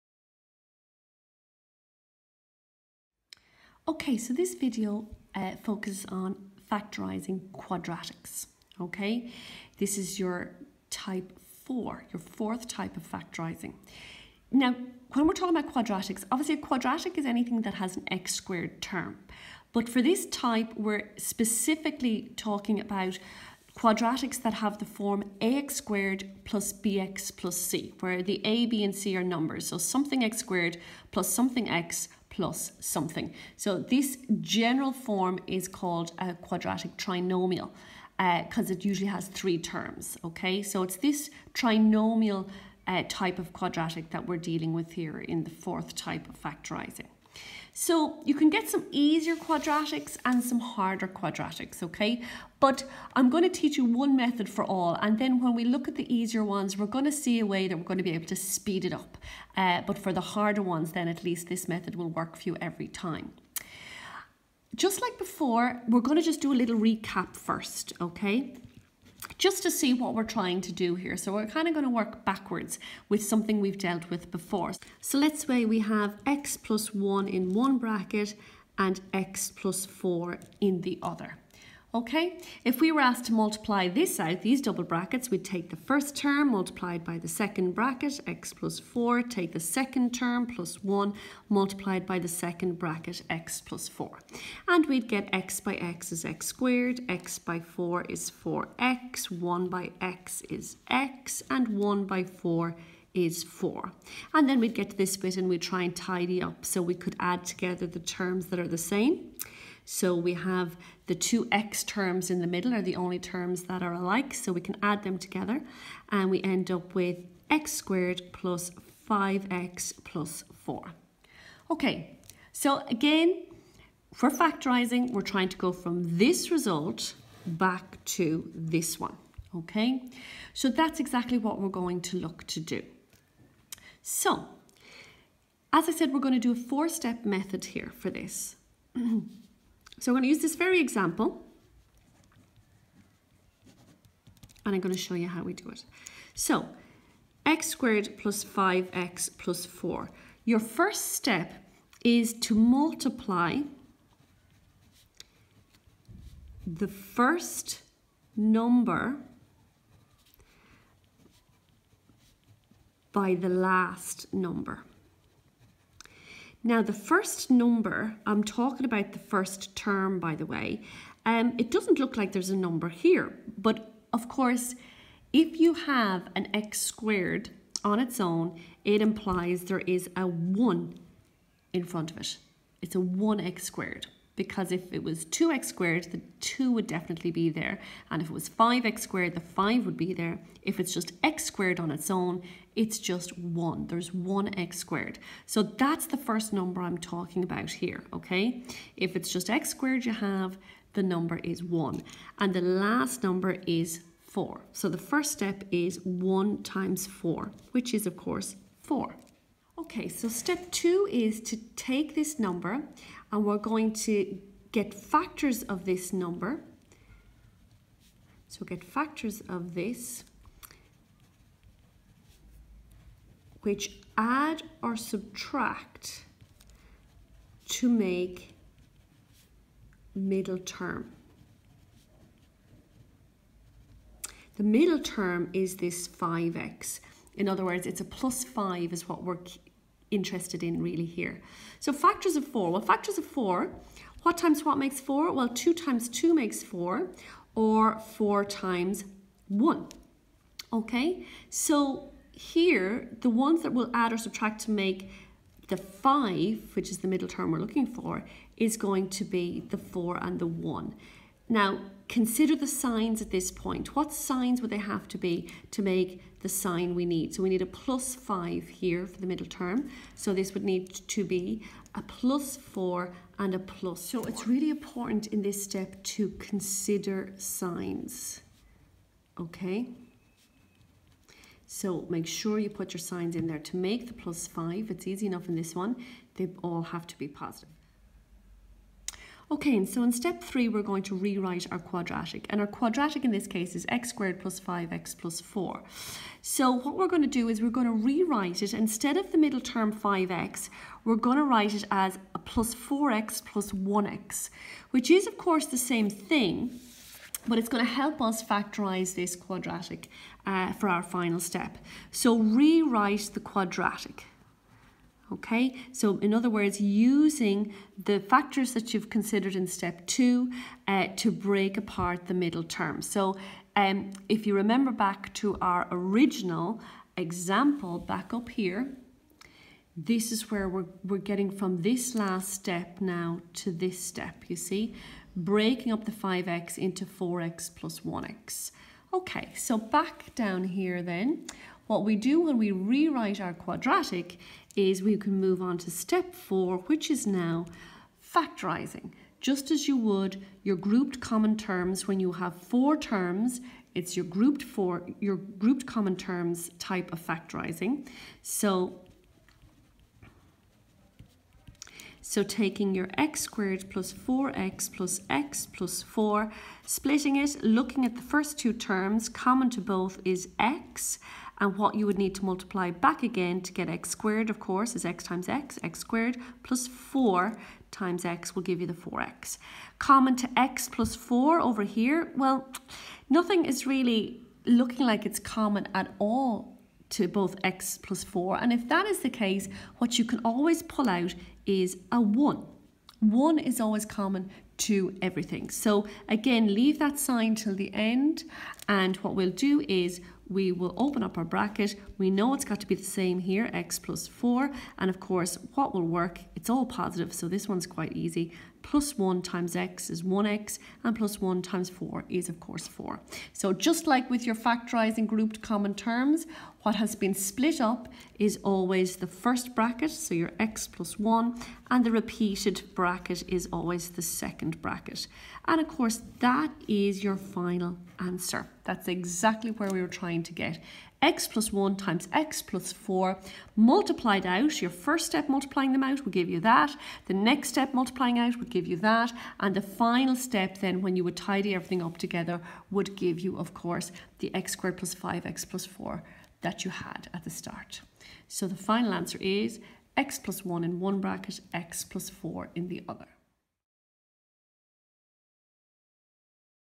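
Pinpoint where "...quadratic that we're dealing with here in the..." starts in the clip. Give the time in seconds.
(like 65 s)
43 s.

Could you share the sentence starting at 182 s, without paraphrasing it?
It's a 1x squared because if it was 2x squared, the 2 would definitely be there.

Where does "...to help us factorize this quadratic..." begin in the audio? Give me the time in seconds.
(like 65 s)
307 s.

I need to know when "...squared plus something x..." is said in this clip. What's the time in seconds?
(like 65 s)
30 s.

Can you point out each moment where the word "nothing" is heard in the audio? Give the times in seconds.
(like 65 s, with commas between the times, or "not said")
383 s.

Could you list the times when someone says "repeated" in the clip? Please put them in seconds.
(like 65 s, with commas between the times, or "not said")
422 s.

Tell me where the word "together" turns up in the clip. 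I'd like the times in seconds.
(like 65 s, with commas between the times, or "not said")
107 s, 115 s, 442 s.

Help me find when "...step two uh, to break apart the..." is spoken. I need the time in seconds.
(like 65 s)
319 s.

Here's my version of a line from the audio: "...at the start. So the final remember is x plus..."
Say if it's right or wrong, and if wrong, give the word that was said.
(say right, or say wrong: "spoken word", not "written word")
wrong: "answer", not "remember".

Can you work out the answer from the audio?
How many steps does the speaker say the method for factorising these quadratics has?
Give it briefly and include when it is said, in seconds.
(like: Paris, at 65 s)
4, at 136 s.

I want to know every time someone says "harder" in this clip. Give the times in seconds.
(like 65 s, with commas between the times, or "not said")
50 s, 60 s.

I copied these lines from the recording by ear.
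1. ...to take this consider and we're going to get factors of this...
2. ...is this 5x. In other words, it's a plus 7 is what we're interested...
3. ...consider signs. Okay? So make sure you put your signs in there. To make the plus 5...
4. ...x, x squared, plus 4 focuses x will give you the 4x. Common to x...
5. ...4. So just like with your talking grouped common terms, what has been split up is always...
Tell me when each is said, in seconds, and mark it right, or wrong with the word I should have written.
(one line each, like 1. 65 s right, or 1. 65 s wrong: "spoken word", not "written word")
1. 211 s wrong: "number", not "consider"
2. 235 s wrong: "5", not "7"
3. 276 s right
4. 375 s wrong: "times", not "focuses"
5. 412 s wrong: "factorising", not "talking".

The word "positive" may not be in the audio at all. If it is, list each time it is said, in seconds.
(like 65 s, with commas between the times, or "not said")
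287 s, 406 s.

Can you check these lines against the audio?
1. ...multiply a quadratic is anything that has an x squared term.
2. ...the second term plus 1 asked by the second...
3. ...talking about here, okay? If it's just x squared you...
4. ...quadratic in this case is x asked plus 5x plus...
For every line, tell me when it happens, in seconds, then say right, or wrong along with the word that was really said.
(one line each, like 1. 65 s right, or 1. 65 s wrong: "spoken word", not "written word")
1. 16 s wrong: "obviously", not "multiply"
2. 89 s wrong: "multiplied", not "asked"
3. 196 s right
4. 292 s wrong: "squared", not "asked".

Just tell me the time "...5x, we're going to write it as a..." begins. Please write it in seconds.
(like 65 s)
299 s.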